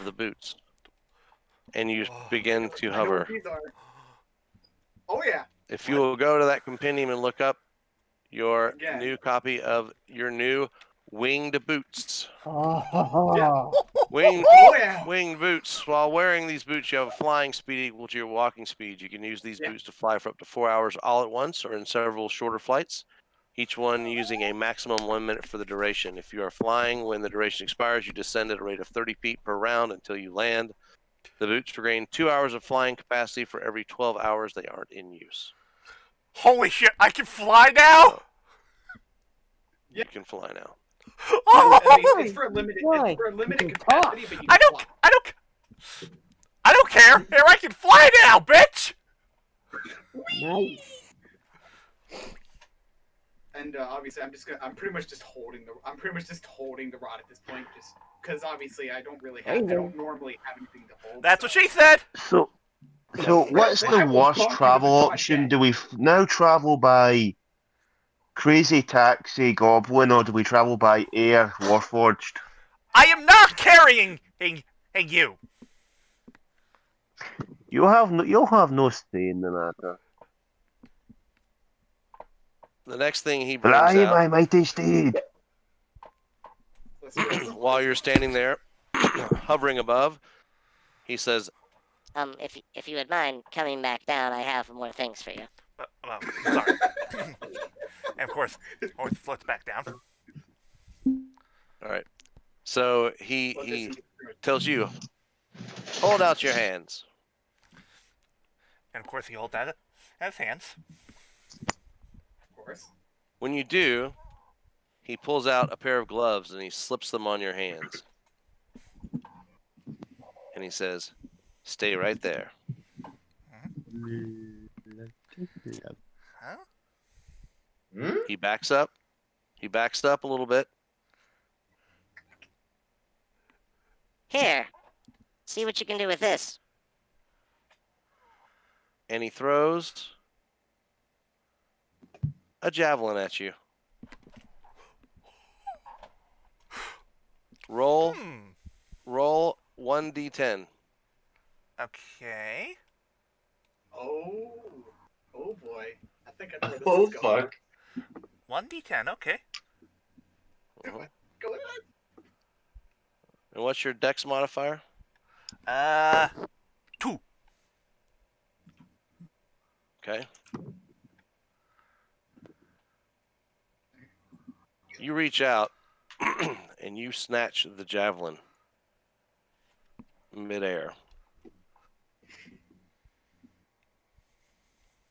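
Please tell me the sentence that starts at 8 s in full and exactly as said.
new copy of your new winged boots.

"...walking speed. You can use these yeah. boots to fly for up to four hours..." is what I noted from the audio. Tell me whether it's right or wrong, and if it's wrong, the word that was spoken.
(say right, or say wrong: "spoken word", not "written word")
right.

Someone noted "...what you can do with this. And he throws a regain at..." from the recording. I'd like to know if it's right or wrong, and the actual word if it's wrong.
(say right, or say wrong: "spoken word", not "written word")
wrong: "javelin", not "regain".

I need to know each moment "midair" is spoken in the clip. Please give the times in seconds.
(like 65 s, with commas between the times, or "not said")
180 s.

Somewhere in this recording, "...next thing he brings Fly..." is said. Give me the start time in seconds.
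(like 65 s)
82 s.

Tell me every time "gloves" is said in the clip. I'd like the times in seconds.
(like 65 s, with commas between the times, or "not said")
116 s.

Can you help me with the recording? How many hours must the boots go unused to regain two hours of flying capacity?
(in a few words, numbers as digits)
12.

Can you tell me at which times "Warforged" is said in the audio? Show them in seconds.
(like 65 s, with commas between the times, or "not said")
71 s.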